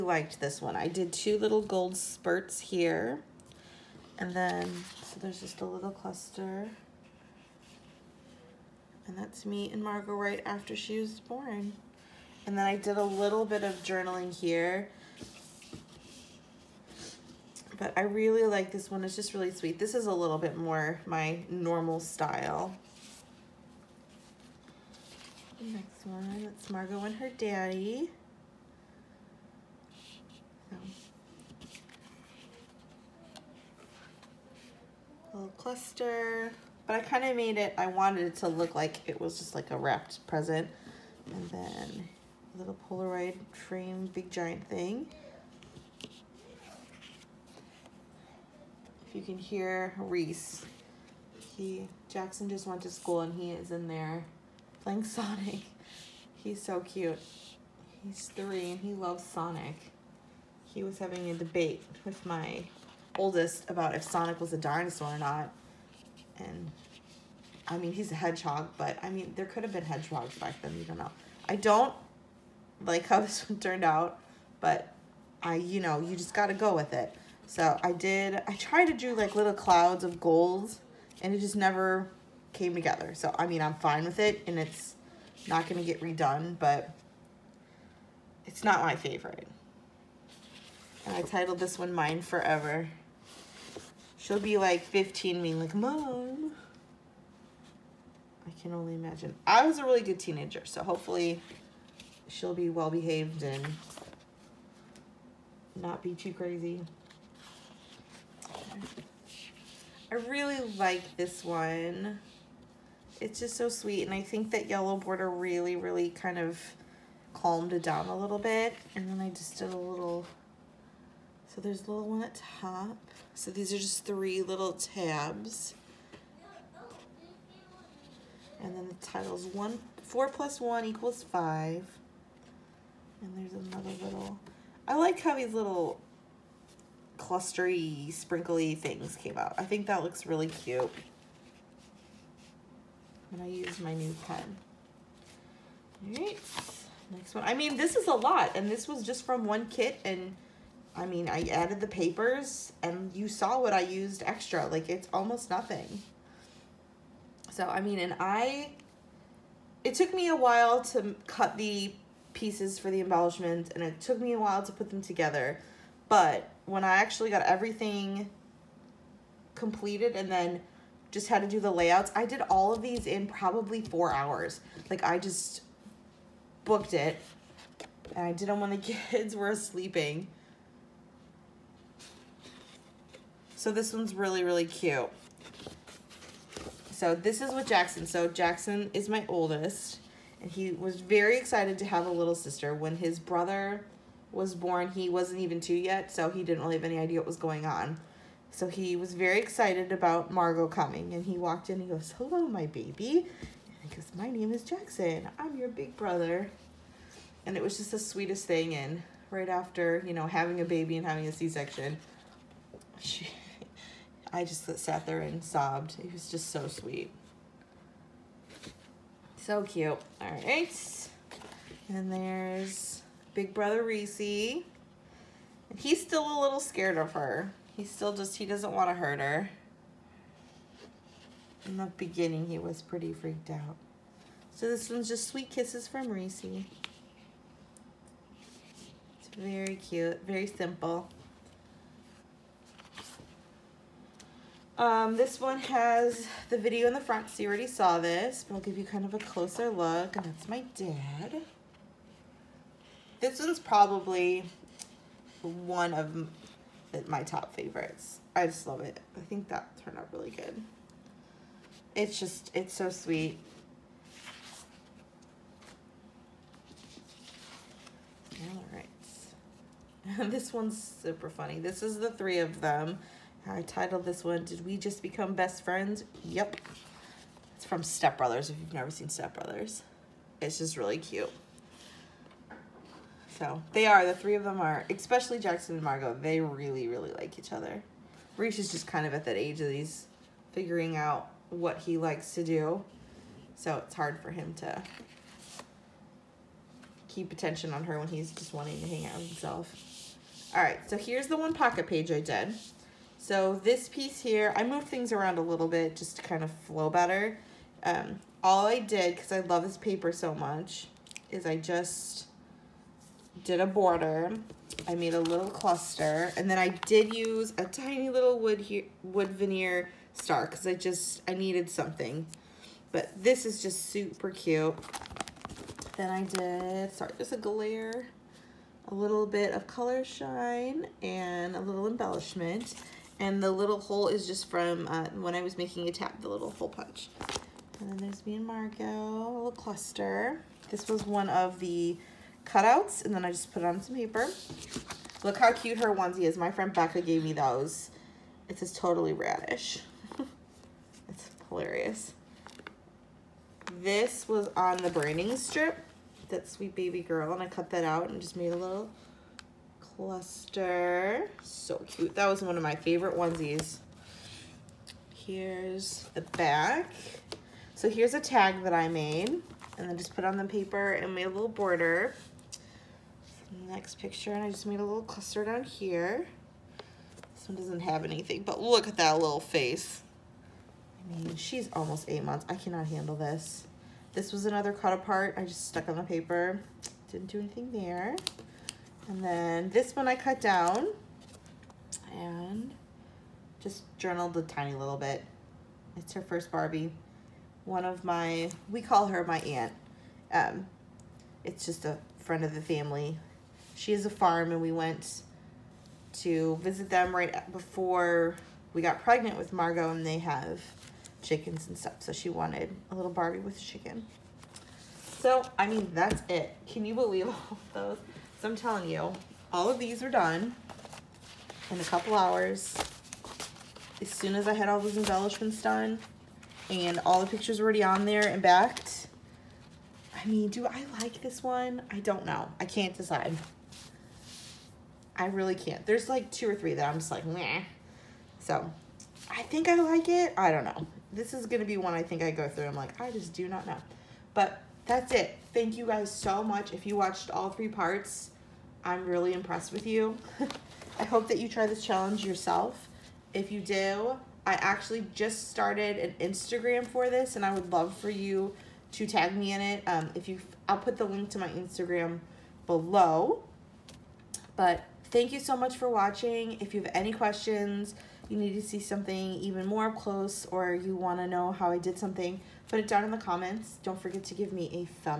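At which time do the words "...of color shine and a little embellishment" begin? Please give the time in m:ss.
5:29.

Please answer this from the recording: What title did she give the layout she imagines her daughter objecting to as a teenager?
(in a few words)
Mine Forever.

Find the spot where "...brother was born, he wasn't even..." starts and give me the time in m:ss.
3:13.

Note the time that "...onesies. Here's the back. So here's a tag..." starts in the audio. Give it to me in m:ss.
6:03.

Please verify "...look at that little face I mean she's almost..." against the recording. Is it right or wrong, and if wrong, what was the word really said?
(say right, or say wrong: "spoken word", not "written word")
right.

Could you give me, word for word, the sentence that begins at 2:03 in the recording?
So these are just three little tabs.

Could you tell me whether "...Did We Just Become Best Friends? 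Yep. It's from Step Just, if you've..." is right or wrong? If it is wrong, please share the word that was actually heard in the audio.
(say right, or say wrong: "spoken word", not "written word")
wrong: "Brothers", not "Just".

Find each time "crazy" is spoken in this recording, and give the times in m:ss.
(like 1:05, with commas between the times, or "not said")
1:46.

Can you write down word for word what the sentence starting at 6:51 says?
So she wanted a little Barbie with chicken.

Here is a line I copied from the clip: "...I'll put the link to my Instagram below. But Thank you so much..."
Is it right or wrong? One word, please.
right.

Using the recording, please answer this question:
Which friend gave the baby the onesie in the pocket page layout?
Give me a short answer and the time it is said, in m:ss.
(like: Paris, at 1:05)
Becca, at 5:46.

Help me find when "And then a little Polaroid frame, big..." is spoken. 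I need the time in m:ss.
0:41.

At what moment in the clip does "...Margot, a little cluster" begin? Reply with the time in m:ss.
5:38.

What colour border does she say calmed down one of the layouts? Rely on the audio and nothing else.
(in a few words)
Yellow.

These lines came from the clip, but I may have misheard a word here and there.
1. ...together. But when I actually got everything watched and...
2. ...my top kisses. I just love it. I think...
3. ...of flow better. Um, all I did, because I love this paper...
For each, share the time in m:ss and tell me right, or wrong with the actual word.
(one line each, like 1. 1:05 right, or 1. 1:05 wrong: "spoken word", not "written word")
1. 2:45 wrong: "completed", not "watched"
2. 4:17 wrong: "favorites", not "kisses"
3. 5:06 right.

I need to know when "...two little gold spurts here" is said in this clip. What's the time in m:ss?
0:01.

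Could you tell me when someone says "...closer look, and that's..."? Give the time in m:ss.
4:09.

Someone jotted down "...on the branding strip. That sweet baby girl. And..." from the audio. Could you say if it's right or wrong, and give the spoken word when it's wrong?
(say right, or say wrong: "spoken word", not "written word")
right.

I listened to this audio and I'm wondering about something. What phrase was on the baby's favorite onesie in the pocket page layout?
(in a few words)
Totally radish.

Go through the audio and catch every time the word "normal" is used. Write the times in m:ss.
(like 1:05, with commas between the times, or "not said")
0:21.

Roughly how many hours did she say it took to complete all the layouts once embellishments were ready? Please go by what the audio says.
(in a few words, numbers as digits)
4.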